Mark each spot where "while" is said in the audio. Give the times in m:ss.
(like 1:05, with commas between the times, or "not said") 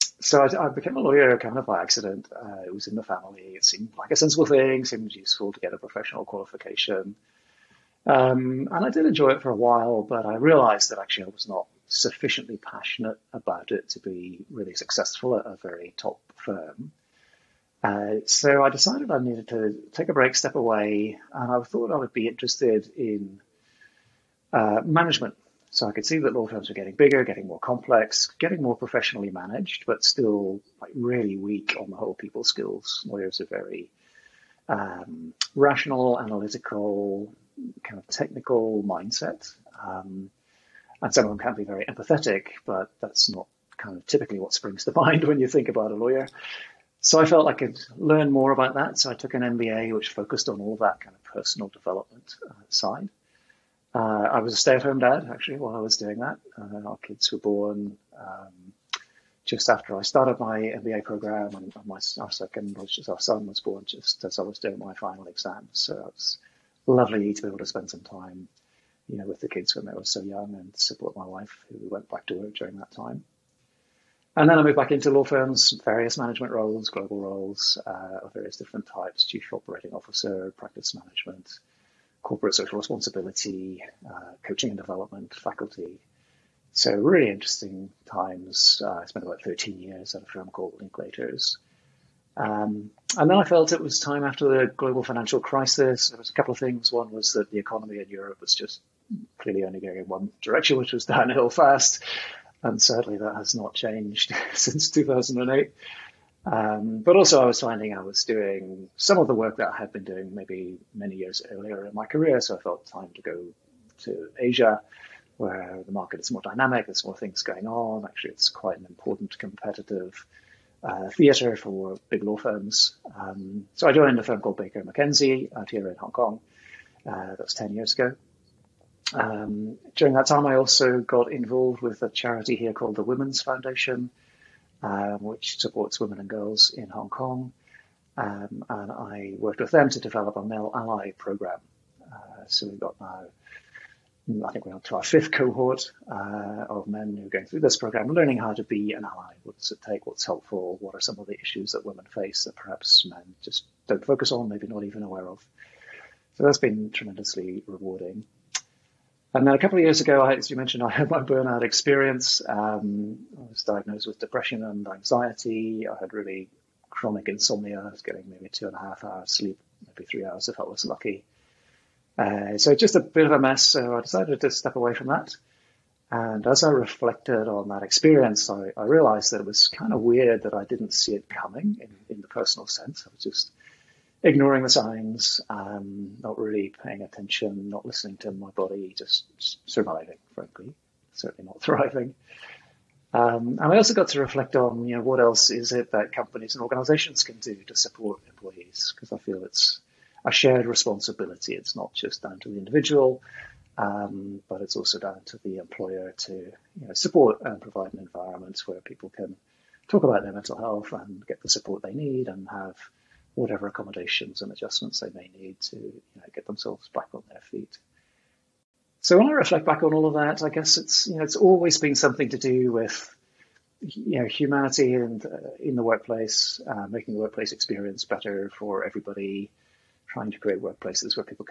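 0:09, 0:55.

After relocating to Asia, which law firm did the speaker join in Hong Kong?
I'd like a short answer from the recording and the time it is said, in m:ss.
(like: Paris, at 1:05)
Baker McKenzie, at 2:04.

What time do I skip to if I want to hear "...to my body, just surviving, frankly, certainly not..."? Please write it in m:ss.
3:08.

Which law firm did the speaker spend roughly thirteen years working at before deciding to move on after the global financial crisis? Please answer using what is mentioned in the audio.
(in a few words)
Linklaters.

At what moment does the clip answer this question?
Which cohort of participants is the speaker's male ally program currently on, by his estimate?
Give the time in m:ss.
2:25.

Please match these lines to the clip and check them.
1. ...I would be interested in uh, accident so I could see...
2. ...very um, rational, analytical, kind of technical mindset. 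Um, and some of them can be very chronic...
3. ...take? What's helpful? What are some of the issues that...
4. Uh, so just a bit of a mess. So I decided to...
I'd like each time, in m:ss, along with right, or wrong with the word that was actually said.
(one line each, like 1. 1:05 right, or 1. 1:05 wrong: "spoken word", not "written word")
1. 0:21 wrong: "management", not "accident"
2. 0:33 wrong: "empathetic", not "chronic"
3. 2:29 right
4. 2:52 right.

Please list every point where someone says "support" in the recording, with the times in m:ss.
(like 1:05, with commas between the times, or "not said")
1:10, 2:15, 3:17, 3:26, 3:31.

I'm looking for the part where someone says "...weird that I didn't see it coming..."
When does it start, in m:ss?
3:00.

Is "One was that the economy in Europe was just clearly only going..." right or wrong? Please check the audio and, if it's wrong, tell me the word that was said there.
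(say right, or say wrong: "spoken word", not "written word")
right.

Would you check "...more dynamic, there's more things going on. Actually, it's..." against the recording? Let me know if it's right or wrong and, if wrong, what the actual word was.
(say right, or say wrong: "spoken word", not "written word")
right.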